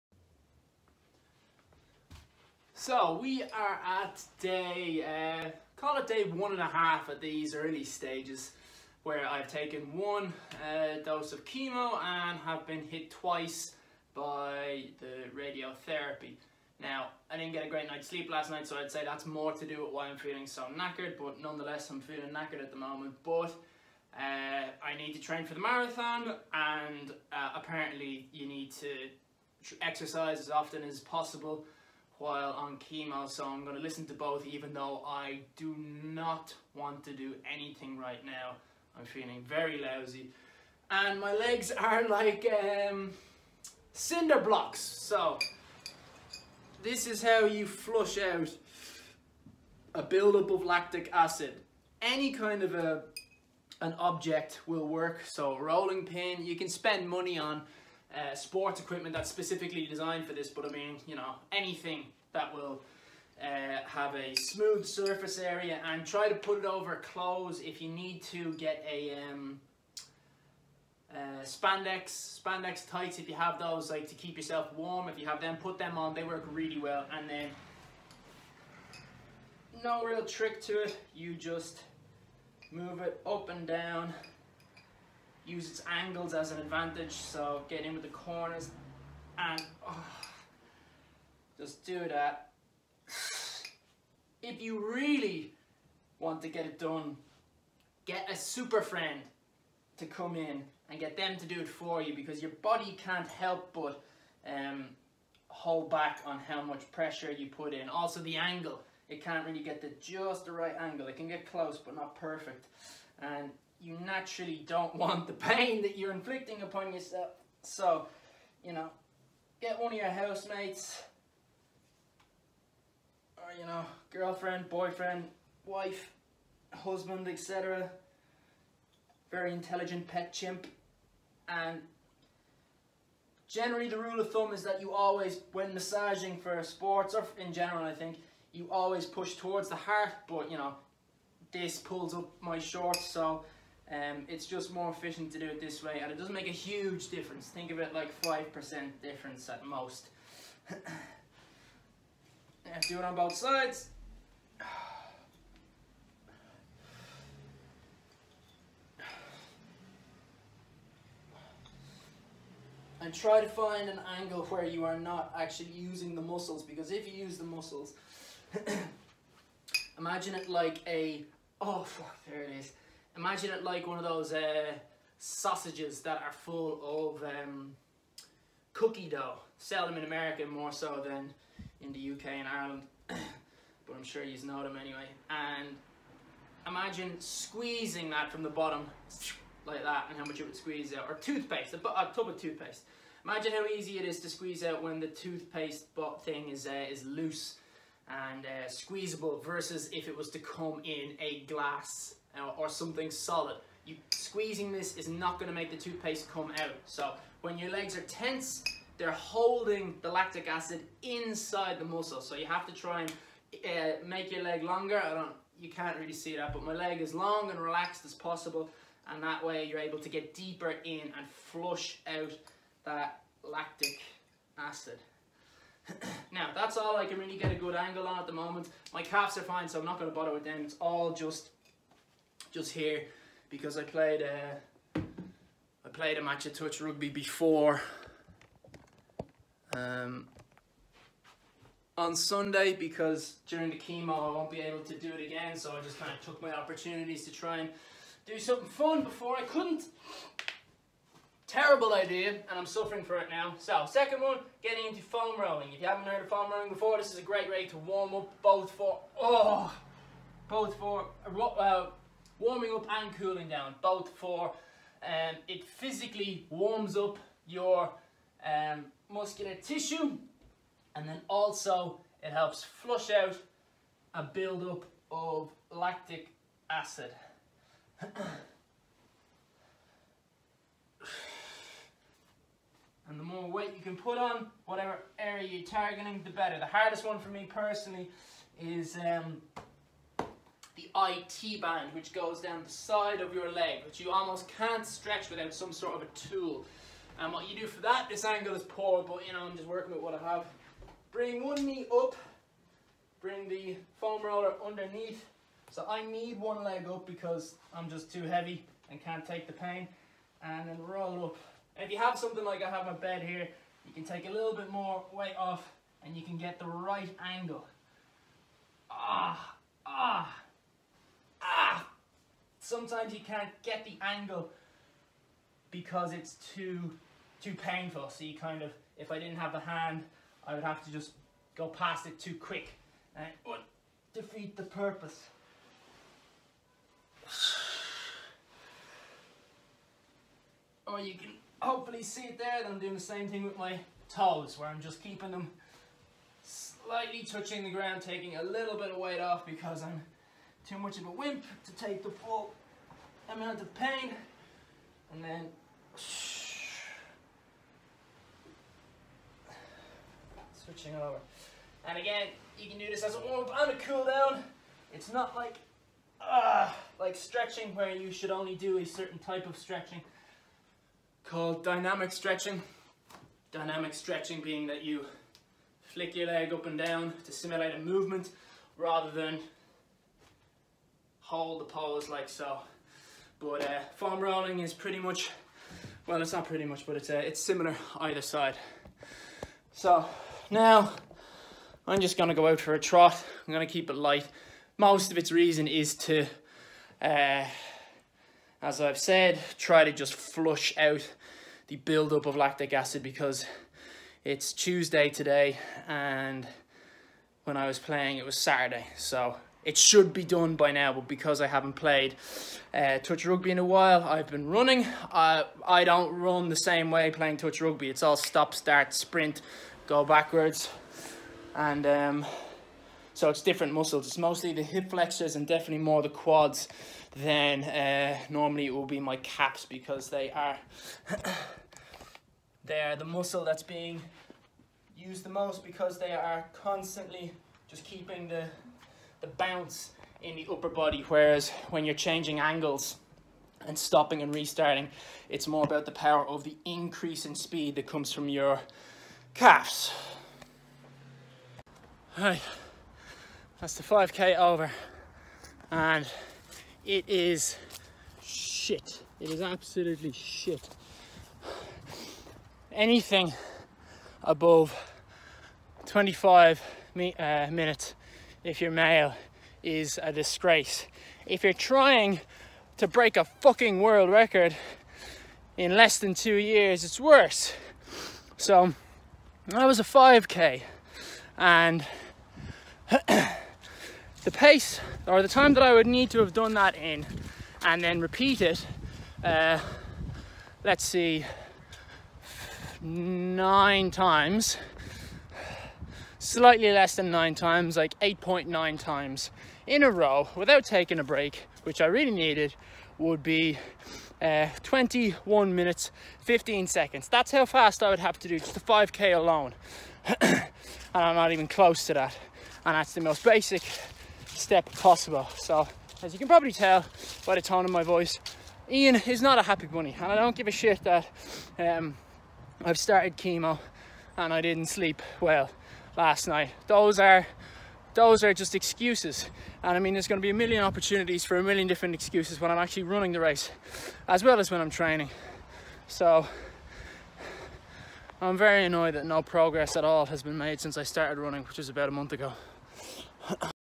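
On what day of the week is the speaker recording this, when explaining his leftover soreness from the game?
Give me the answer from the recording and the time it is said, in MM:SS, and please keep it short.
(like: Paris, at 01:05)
Tuesday, at 06:44.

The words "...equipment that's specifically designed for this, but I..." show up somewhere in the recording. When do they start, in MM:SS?
00:58.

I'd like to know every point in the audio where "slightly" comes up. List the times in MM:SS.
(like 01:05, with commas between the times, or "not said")
05:46, 08:16.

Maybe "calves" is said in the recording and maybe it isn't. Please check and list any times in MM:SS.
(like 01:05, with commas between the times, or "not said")
03:49, 07:29.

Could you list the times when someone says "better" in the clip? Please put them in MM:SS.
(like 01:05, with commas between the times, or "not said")
04:46.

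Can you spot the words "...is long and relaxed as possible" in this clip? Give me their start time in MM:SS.
03:37.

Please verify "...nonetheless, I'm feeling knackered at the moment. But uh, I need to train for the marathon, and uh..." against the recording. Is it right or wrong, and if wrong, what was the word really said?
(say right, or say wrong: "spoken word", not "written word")
right.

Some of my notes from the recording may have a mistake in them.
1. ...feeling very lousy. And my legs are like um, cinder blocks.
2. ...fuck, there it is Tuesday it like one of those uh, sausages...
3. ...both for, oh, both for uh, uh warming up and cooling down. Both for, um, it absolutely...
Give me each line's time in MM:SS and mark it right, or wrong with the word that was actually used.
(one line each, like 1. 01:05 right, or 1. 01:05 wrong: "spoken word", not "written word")
1. 00:39 right
2. 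02:51 wrong: "Imagine", not "Tuesday"
3. 04:18 wrong: "physically", not "absolutely".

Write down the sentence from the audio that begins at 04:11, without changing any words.
Terrible idea, and I'm suffering for it now.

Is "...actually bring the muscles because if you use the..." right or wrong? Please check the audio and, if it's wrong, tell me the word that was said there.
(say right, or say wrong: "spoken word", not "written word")
wrong: "using", not "bring".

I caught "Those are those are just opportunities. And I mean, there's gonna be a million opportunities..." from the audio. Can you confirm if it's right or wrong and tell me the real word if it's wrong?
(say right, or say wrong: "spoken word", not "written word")
wrong: "excuses", not "opportunities".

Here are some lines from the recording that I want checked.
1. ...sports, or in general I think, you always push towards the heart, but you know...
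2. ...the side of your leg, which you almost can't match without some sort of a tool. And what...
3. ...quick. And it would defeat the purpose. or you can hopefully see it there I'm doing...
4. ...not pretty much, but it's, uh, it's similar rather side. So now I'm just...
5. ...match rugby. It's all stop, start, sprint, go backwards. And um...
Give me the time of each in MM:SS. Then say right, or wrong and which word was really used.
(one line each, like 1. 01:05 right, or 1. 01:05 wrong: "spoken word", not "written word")
1. 02:16 right
2. 04:52 wrong: "stretch", not "match"
3. 05:32 right
4. 06:26 wrong: "either", not "rather"
5. 06:57 wrong: "touch", not "match".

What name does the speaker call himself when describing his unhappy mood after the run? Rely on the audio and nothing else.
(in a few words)
Ian.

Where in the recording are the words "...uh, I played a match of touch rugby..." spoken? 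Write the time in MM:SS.
03:54.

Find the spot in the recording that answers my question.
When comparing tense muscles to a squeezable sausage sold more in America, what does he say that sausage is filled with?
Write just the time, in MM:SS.
02:58.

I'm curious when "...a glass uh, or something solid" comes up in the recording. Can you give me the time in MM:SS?
03:21.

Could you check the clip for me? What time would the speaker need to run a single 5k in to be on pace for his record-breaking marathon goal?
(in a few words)
21 minutes 15 seconds.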